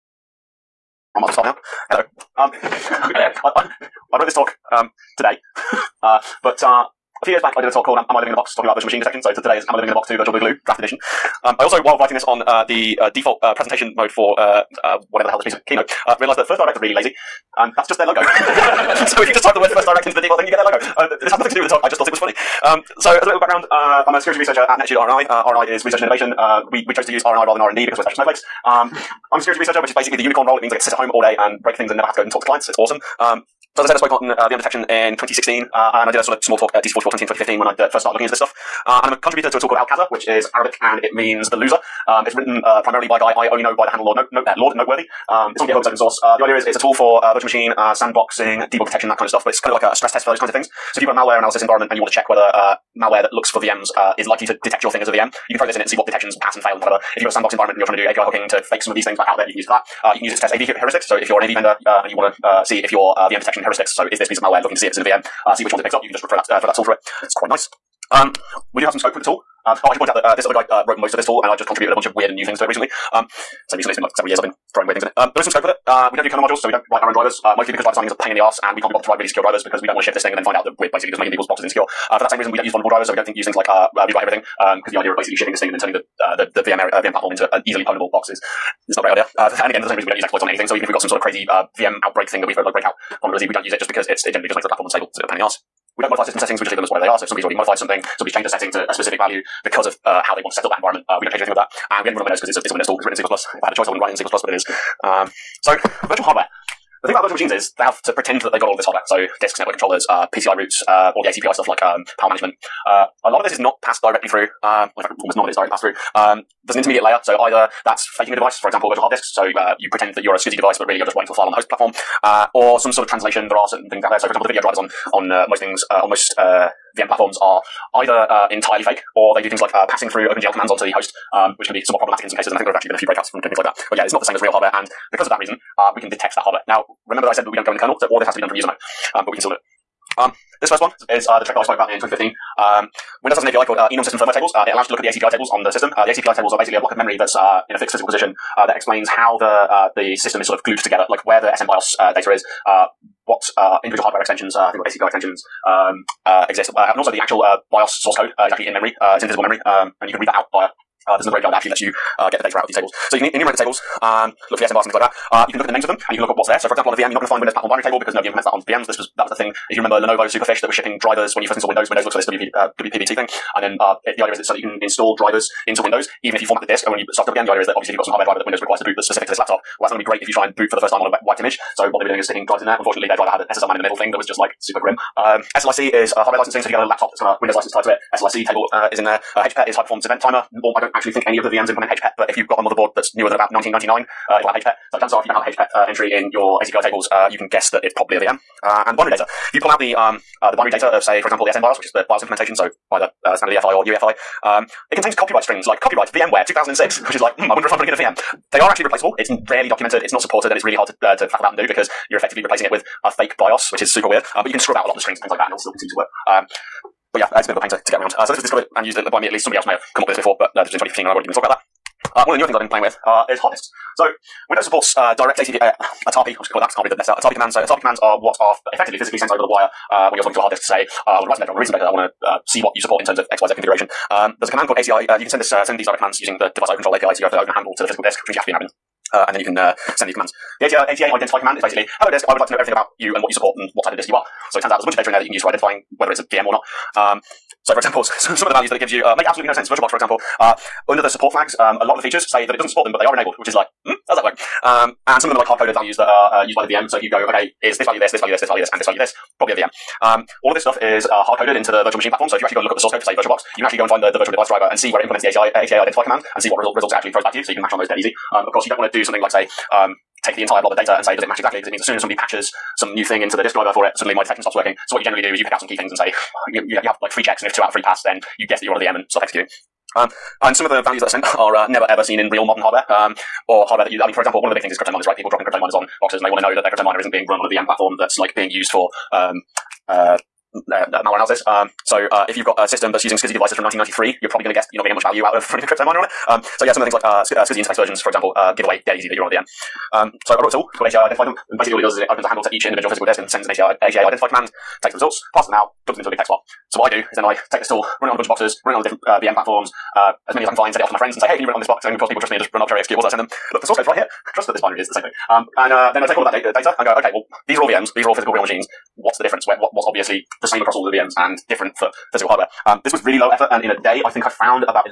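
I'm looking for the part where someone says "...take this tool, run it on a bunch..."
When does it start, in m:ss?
5:07.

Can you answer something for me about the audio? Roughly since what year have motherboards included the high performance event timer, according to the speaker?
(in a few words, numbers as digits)
1999.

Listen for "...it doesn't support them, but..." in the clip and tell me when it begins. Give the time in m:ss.
4:12.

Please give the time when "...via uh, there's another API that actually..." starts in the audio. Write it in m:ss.
2:40.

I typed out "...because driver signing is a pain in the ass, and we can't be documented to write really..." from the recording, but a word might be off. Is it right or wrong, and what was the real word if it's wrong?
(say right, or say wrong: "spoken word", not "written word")
wrong: "bothered", not "documented".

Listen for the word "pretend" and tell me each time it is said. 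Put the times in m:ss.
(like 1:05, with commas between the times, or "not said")
1:48, 1:59.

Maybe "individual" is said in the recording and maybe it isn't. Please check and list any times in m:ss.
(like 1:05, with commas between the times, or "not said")
2:33, 5:02.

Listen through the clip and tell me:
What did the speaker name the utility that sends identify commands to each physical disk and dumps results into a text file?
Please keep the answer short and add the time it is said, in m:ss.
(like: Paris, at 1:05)
ATA Identify Dump, at 5:00.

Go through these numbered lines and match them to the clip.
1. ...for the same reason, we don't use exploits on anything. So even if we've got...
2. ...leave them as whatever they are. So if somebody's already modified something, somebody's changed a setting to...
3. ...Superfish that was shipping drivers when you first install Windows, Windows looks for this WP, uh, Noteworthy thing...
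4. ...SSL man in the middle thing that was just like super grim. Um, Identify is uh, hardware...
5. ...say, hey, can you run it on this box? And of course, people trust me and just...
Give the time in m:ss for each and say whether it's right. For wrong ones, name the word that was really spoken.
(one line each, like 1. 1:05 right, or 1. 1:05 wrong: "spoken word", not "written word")
1. 1:29 right
2. 1:36 right
3. 2:50 wrong: "WPBT", not "Noteworthy"
4. 3:03 wrong: "SLIC", not "Identify"
5. 5:11 right.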